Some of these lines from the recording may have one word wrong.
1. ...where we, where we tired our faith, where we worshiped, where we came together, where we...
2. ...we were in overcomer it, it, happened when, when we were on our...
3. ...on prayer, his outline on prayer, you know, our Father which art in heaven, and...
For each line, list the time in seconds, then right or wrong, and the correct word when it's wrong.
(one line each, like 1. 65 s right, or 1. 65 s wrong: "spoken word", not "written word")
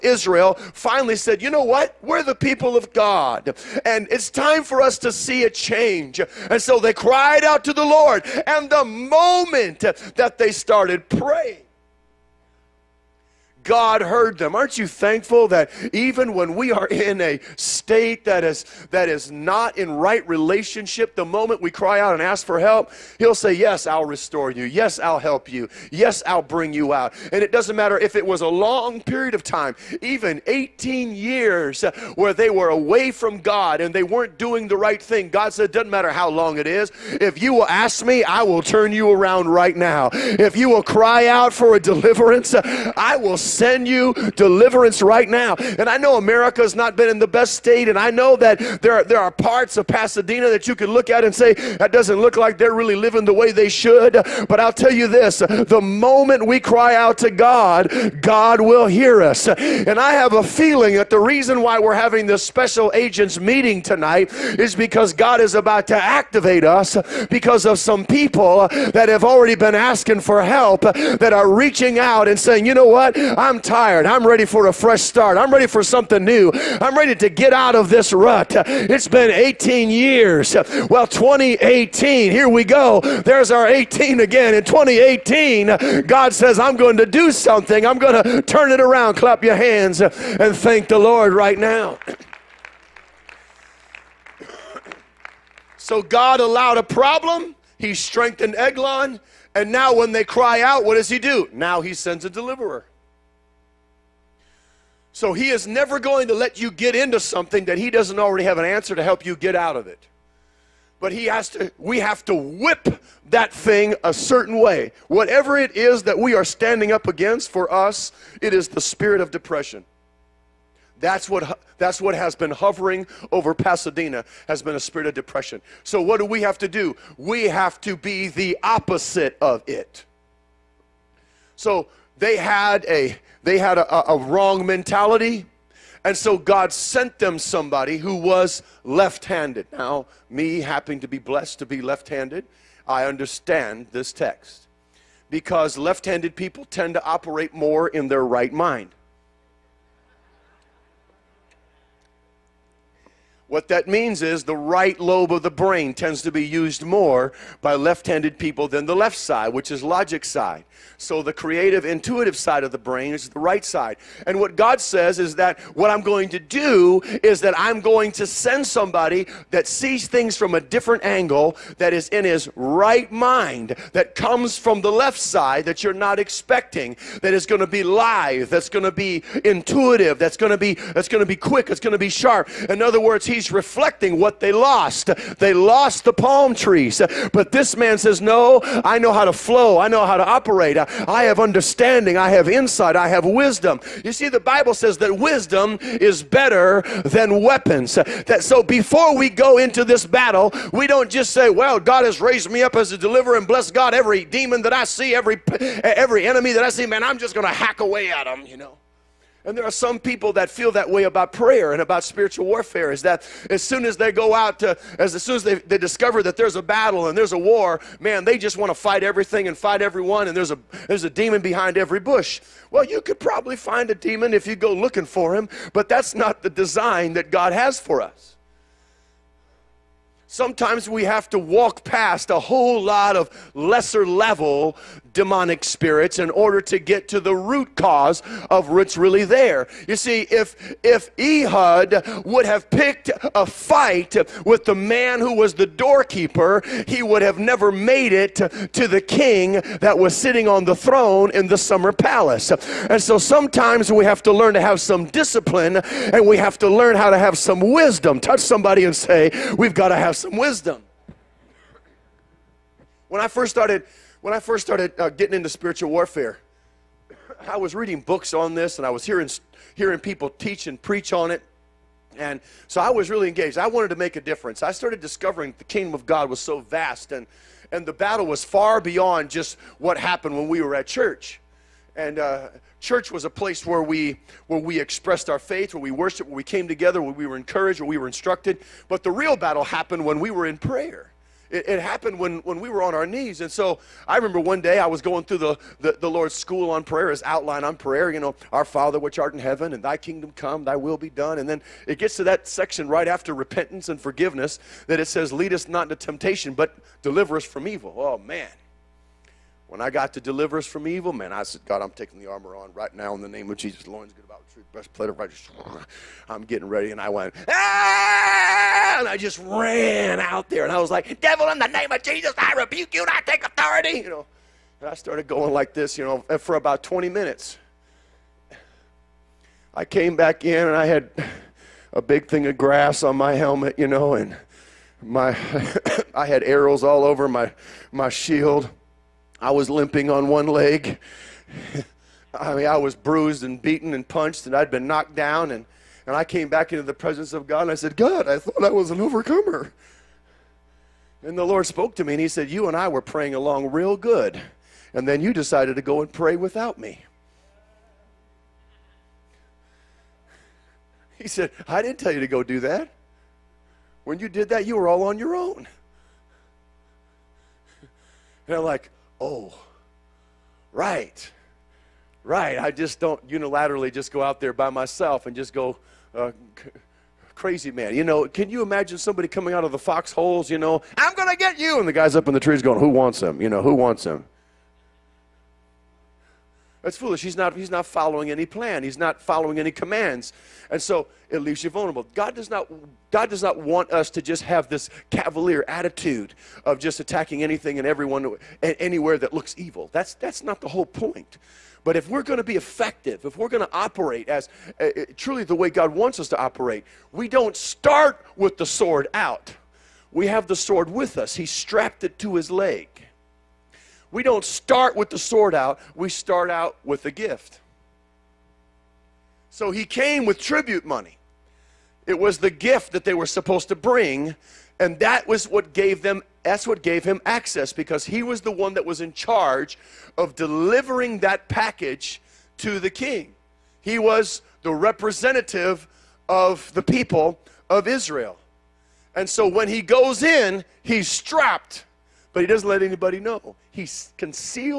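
1. 283 s wrong: "expressed", not "tired"
2. 290 s wrong: "prayer", not "overcomer"
3. 296 s right.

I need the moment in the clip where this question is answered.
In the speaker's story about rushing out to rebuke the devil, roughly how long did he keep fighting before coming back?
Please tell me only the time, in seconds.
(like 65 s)
326 s.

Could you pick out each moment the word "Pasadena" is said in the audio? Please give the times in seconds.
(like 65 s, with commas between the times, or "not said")
49 s, 123 s.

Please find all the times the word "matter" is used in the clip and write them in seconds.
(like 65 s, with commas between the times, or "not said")
27 s, 35 s.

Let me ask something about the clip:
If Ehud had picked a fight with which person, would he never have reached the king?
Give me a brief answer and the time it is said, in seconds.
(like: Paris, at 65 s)
the doorkeeper, at 245 s.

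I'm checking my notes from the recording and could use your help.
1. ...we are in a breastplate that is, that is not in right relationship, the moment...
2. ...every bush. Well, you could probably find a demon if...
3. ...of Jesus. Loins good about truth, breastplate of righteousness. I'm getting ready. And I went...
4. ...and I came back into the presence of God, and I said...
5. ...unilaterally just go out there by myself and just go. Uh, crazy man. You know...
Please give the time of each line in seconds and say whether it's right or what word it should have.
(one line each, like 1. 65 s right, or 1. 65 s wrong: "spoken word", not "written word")
1. 16 s wrong: "state", not "breastplate"
2. 221 s right
3. 313 s right
4. 346 s right
5. 373 s right.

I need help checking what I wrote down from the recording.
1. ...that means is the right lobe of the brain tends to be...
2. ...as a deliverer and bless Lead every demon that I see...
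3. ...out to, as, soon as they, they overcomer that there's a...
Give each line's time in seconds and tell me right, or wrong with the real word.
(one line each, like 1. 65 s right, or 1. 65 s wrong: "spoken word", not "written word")
1. 153 s right
2. 202 s wrong: "God", not "Lead"
3. 214 s wrong: "discover", not "overcomer".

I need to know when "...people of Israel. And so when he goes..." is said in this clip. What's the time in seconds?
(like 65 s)
436 s.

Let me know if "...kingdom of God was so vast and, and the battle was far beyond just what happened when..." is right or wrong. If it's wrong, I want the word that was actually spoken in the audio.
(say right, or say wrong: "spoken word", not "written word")
right.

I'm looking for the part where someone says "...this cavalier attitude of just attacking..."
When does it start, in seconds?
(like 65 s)
394 s.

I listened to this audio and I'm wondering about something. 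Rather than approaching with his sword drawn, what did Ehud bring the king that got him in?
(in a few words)
tribute money.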